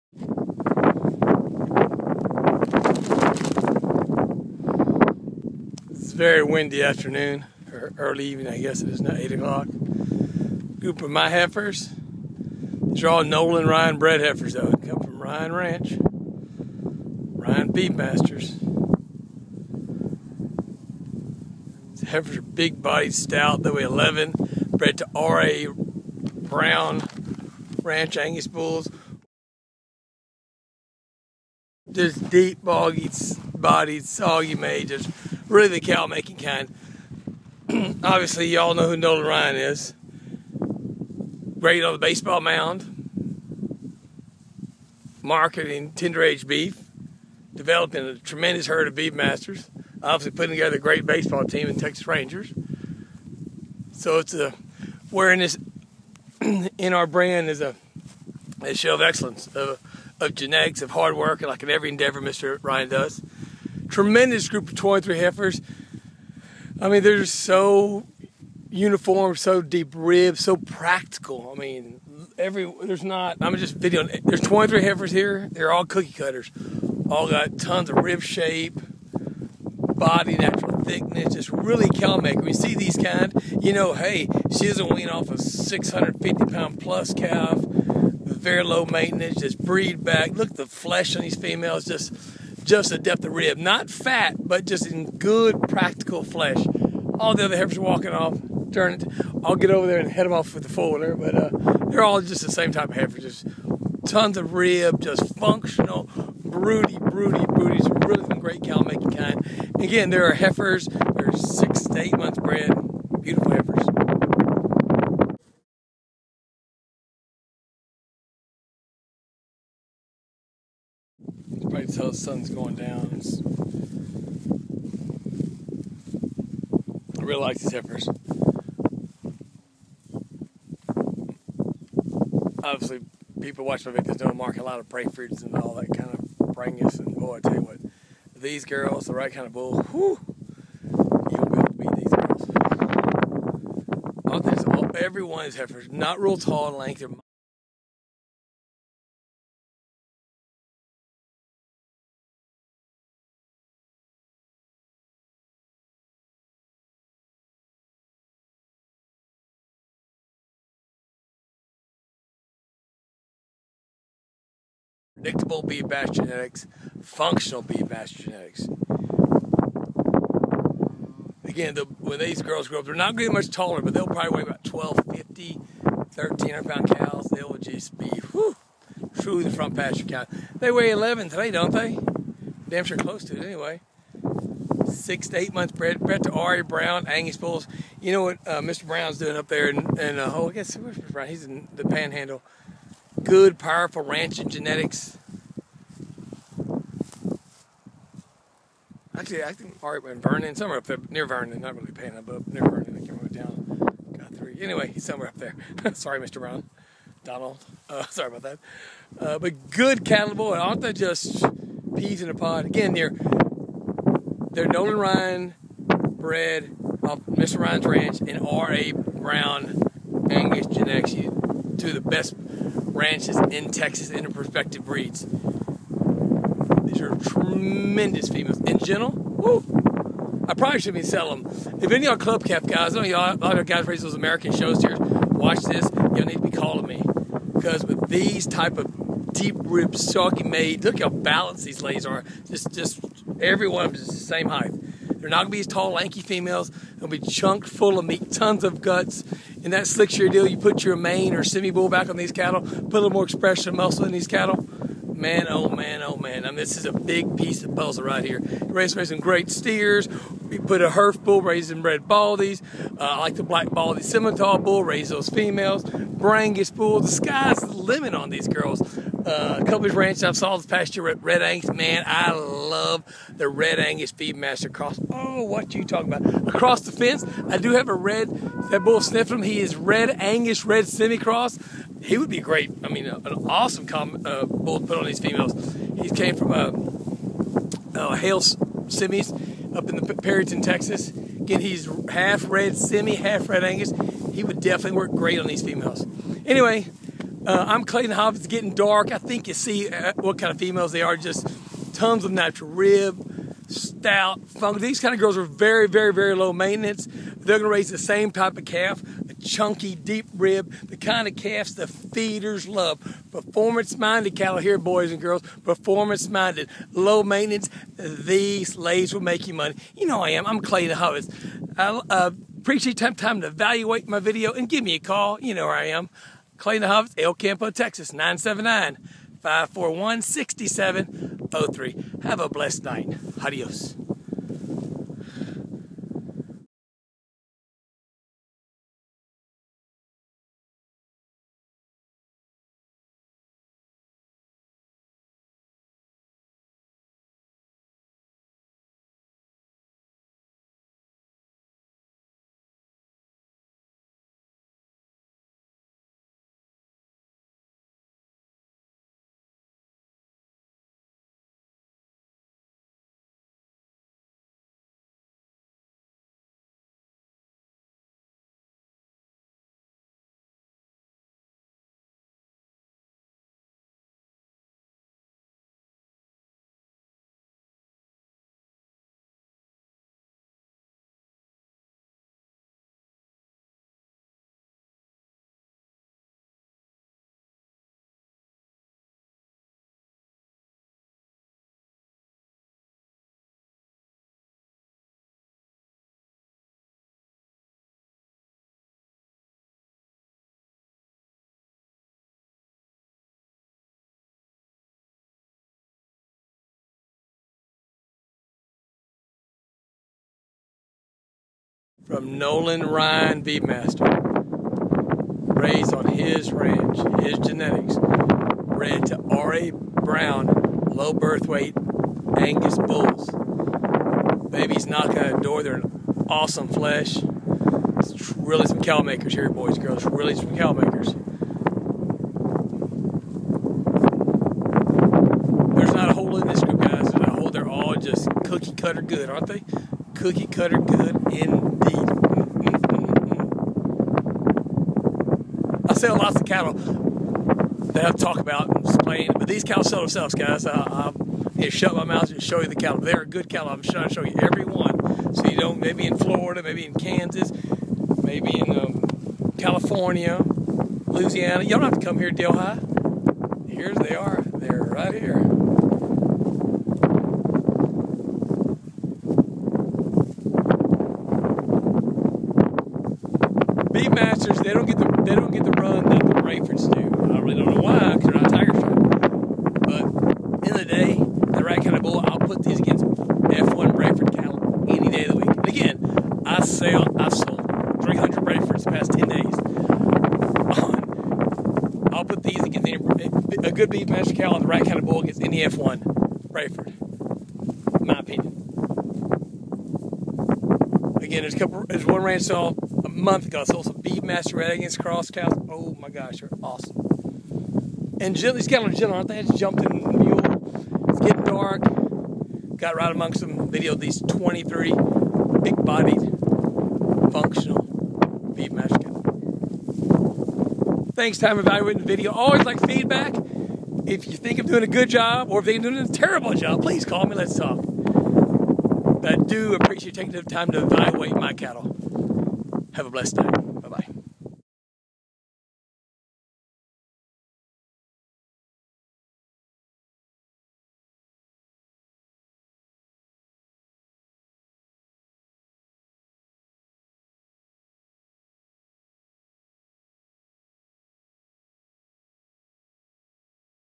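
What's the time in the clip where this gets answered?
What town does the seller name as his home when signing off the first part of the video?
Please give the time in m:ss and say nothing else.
5:27.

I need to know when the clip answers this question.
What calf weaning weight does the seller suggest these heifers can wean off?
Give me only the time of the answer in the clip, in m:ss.
1:25.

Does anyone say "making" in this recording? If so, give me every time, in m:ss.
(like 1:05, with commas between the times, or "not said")
0:36, 1:48.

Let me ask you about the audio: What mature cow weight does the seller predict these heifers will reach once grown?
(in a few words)
1250 to 1300 pounds.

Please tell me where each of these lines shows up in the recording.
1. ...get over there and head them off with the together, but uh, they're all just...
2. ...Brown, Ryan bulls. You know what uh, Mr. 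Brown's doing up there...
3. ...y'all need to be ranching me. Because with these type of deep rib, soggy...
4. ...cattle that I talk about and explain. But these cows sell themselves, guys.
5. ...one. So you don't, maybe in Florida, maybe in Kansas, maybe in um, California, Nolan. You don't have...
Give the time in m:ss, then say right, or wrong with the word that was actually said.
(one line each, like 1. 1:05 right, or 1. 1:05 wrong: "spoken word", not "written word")
1. 1:39 wrong: "folder", not "together"
2. 3:06 wrong: "Angus", not "Ryan"
3. 3:55 wrong: "calling", not "ranching"
4. 7:26 right
5. 7:34 wrong: "Louisiana", not "Nolan".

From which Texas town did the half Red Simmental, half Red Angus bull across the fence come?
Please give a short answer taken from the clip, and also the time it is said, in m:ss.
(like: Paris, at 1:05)
Perryton, at 4:50.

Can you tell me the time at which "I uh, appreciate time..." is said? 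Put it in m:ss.
5:21.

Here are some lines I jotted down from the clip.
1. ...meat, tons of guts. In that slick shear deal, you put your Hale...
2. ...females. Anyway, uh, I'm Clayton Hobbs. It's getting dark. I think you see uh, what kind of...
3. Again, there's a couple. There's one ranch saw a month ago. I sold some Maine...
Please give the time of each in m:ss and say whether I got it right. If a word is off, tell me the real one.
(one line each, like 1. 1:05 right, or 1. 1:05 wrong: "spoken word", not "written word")
1. 4:08 wrong: "Maine", not "Hale"
2. 4:55 right
3. 8:21 wrong: "Beefmaster", not "Maine".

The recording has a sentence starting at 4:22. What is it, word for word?
Uh, I like the black baldy scimitar bull, raise those females.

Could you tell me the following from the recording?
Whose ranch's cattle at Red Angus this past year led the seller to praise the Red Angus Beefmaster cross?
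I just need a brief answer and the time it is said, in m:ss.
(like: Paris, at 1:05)
Cubby's Ranch, at 4:29.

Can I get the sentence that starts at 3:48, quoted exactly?
In general, woo, I probably shouldn't be selling them.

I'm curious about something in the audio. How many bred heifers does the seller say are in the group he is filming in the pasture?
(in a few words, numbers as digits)
23.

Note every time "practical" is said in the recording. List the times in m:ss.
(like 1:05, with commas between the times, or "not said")
1:10, 1:35.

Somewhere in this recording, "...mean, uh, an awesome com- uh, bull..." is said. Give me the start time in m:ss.
4:42.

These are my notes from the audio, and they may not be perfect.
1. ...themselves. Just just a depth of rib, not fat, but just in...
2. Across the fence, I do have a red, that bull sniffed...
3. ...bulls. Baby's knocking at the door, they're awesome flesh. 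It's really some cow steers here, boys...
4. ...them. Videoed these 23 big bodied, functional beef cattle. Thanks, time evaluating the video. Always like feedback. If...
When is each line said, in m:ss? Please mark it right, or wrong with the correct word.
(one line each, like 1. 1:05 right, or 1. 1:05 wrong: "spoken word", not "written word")
1. 1:31 wrong: "females", not "themselves"
2. 4:36 right
3. 7:02 wrong: "makers", not "steers"
4. 8:33 right.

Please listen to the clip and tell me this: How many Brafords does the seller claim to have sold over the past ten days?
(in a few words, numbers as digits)
300.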